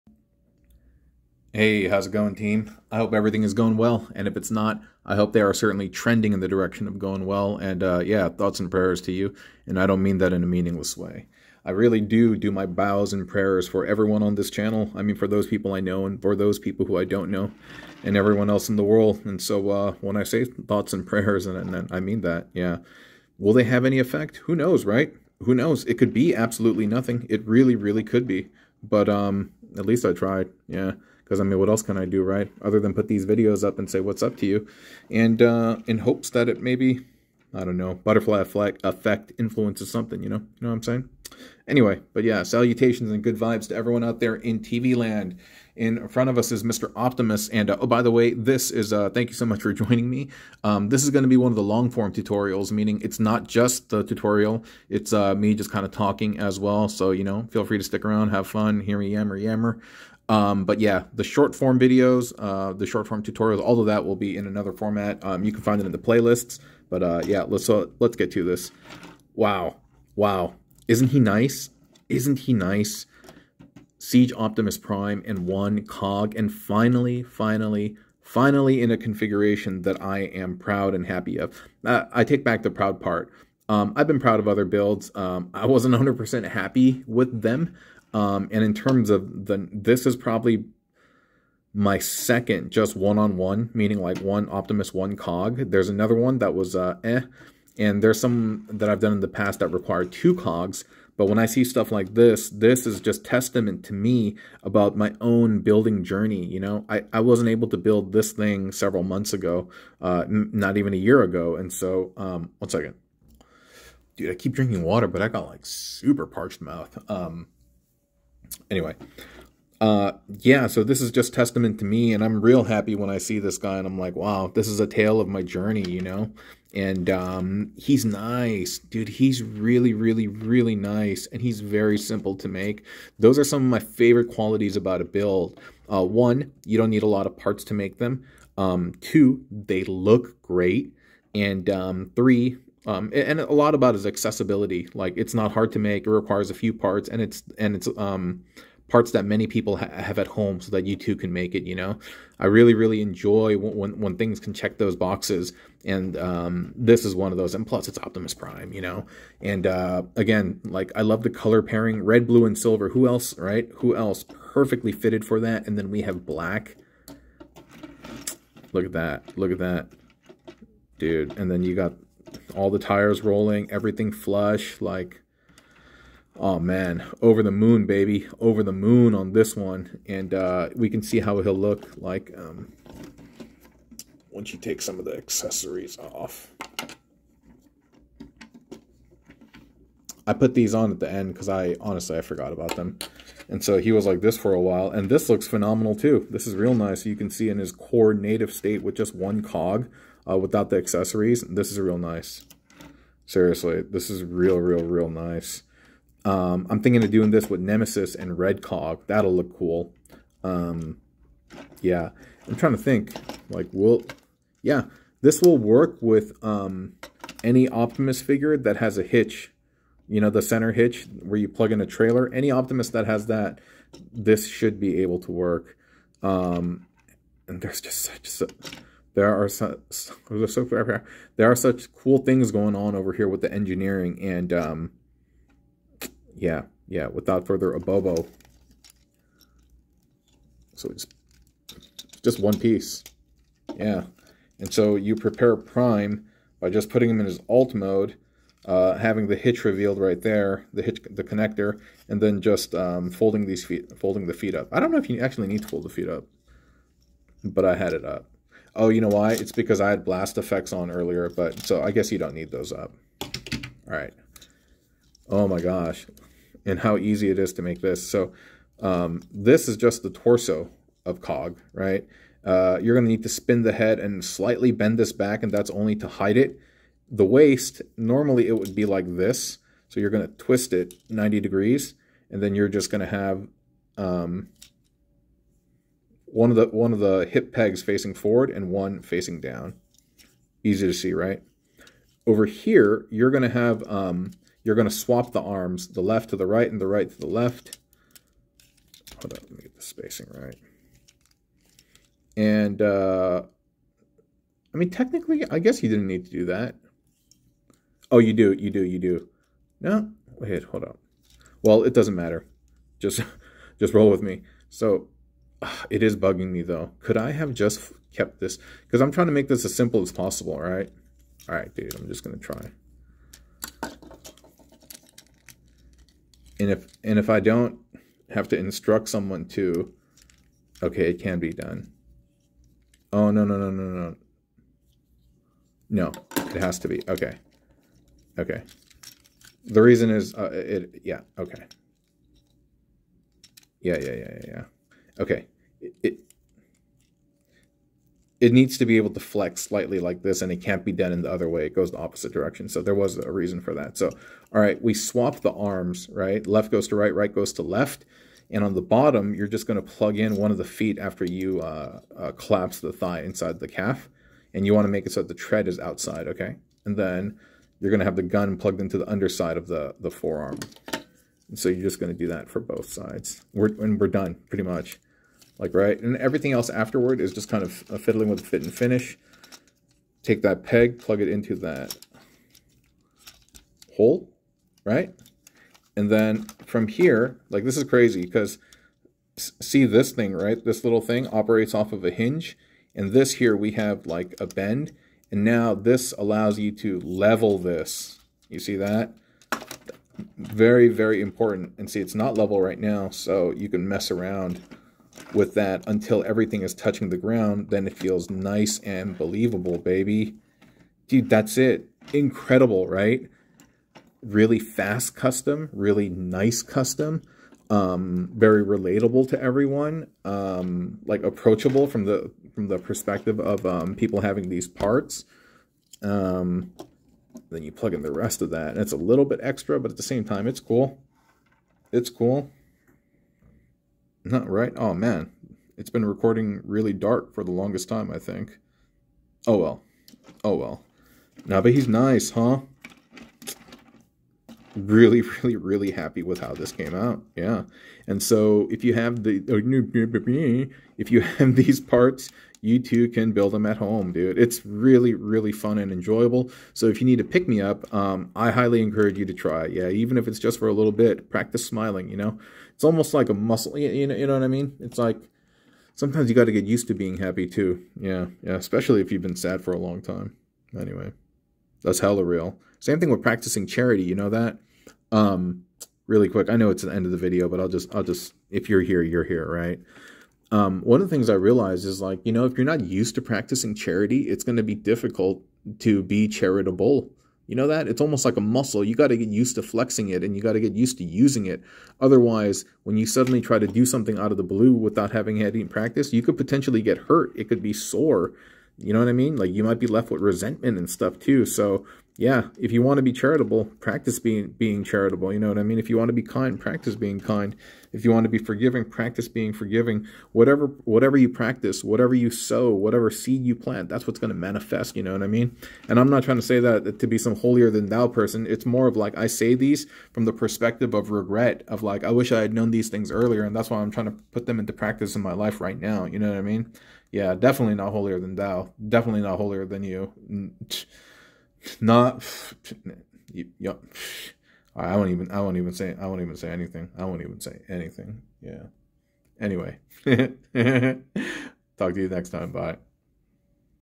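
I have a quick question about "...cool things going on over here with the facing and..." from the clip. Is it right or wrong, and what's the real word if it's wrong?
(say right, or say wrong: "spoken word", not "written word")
wrong: "engineering", not "facing".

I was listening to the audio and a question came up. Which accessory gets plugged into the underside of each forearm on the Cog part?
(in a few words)
the gun.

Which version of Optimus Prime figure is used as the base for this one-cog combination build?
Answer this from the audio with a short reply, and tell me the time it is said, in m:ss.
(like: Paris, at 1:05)
Siege, at 1:13.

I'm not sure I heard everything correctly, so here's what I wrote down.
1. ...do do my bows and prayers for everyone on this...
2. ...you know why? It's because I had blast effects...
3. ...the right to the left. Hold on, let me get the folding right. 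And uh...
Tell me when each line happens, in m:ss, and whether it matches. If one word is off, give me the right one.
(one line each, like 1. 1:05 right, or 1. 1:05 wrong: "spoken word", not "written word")
1. 0:11 right
2. 4:18 right
3. 4:56 wrong: "spacing", not "folding".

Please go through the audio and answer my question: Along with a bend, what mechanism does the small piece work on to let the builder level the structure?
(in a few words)
a hinge.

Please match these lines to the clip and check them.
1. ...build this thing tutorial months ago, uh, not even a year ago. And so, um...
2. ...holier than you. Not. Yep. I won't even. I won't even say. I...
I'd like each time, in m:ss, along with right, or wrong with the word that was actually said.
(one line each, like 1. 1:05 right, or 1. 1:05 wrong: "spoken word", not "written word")
1. 1:47 wrong: "several", not "tutorial"
2. 8:49 right.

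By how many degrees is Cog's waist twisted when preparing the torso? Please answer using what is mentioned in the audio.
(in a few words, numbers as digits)
90.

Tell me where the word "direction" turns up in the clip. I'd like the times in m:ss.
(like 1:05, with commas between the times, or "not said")
0:06, 5:52.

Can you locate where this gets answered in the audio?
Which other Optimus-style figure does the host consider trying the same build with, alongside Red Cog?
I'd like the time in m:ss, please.
3:27.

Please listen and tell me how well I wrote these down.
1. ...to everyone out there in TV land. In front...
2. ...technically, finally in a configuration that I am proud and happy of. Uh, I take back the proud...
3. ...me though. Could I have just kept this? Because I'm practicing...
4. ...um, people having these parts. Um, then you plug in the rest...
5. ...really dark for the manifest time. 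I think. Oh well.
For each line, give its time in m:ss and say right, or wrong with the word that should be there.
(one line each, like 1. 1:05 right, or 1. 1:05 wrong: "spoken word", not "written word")
1. 0:43 right
2. 1:17 wrong: "finally", not "technically"
3. 5:16 wrong: "trying", not "practicing"
4. 7:03 right
5. 7:16 wrong: "longest", not "manifest".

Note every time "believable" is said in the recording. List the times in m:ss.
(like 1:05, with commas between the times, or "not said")
6:49.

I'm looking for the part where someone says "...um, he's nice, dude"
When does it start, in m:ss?
2:07.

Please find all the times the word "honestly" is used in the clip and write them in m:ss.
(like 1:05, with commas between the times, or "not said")
3:11.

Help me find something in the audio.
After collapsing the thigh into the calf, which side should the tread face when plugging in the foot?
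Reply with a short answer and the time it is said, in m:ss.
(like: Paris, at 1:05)
outside, at 6:05.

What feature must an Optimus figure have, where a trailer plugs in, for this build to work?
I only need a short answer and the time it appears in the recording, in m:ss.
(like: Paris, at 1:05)
center hitch, at 3:40.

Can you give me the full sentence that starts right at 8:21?
So yeah, if you want to be charitable, practice being being charitable.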